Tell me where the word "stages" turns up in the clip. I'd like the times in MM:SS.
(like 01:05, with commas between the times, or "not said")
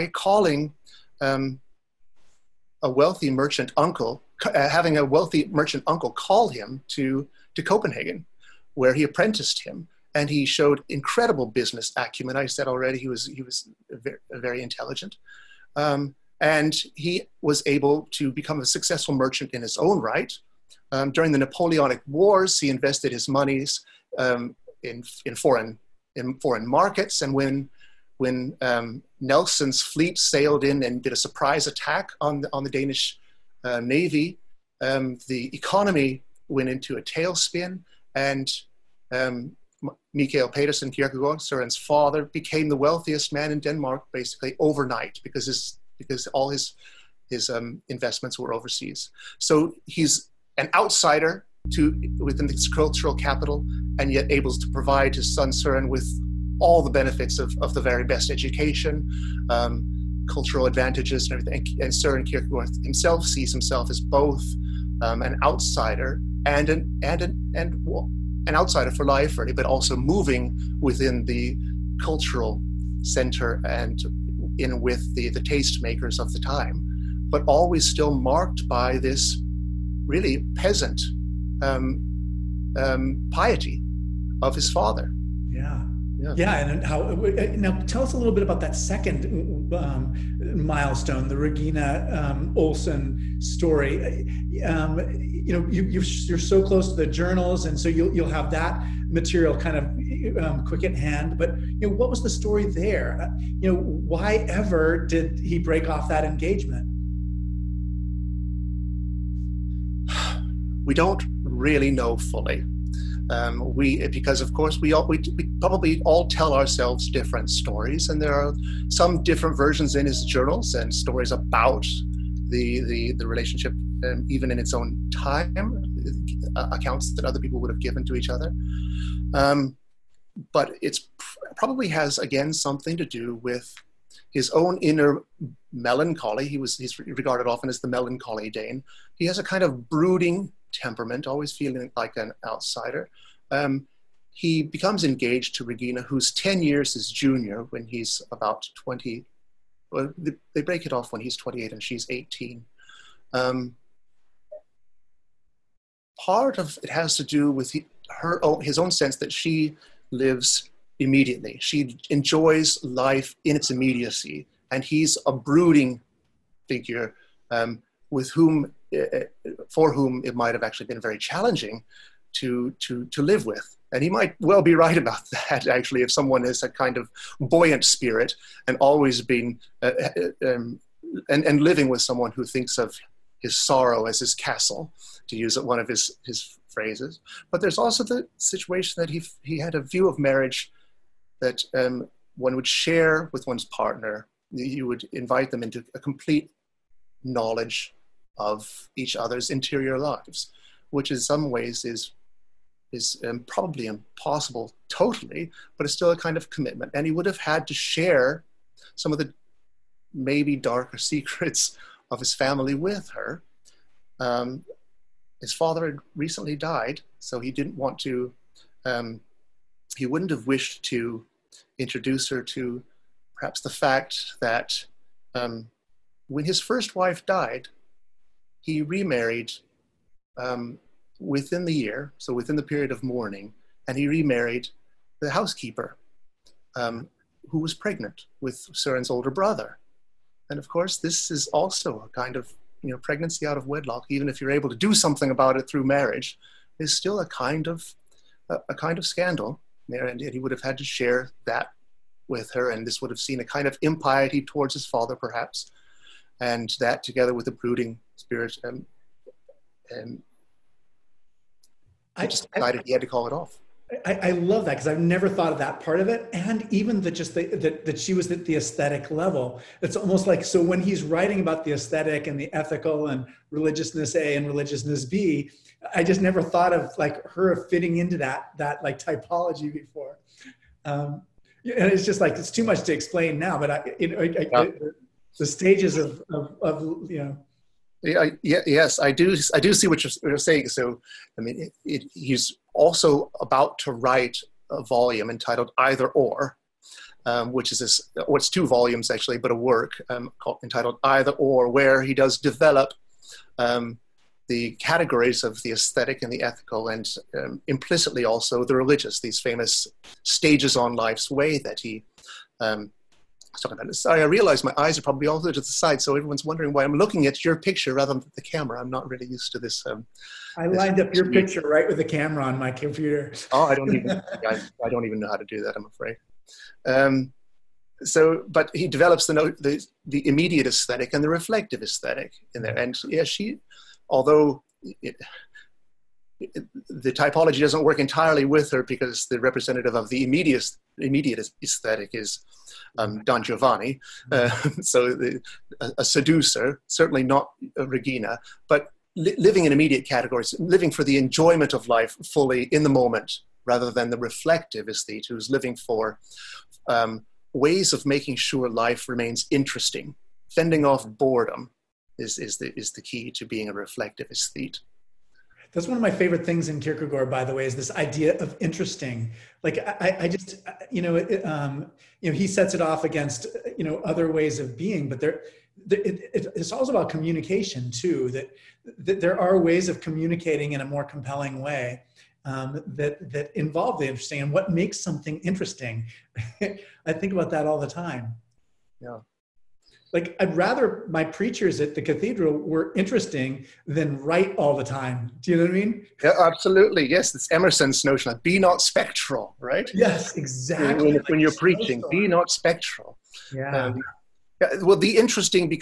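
04:45, 05:10.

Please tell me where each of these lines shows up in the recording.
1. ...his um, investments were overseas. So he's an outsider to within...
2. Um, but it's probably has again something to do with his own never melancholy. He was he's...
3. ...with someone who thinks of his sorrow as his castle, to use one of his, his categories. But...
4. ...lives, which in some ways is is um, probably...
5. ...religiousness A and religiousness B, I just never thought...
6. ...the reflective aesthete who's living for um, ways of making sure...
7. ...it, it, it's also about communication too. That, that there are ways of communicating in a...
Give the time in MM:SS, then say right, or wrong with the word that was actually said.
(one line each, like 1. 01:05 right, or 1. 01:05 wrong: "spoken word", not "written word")
1. 00:47 right
2. 02:09 wrong: "inner", not "never"
3. 03:01 wrong: "phrases", not "categories"
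4. 03:19 right
5. 04:33 right
6. 05:54 right
7. 06:15 right.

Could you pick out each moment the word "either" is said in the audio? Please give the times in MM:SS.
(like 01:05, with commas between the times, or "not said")
04:55, 05:01.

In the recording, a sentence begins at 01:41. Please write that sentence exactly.
But you know, what was the story there?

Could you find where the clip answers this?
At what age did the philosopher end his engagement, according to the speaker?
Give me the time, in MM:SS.
02:31.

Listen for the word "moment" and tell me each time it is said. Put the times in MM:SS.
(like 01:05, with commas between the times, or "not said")
05:52.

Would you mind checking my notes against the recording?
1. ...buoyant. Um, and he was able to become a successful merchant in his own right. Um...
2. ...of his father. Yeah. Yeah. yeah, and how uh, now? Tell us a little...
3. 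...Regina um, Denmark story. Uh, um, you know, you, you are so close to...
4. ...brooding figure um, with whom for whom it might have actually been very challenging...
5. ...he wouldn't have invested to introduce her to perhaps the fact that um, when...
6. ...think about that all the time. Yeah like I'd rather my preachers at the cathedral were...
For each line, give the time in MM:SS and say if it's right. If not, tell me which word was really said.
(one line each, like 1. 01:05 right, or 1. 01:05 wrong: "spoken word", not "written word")
1. 00:14 wrong: "intelligent", not "buoyant"
2. 01:24 right
3. 01:31 wrong: "Olsen", not "Denmark"
4. 02:45 right
5. 03:39 wrong: "wished", not "invested"
6. 06:27 right.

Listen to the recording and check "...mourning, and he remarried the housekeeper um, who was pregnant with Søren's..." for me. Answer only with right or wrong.
right.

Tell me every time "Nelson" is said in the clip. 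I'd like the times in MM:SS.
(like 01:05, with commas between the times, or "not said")
00:29.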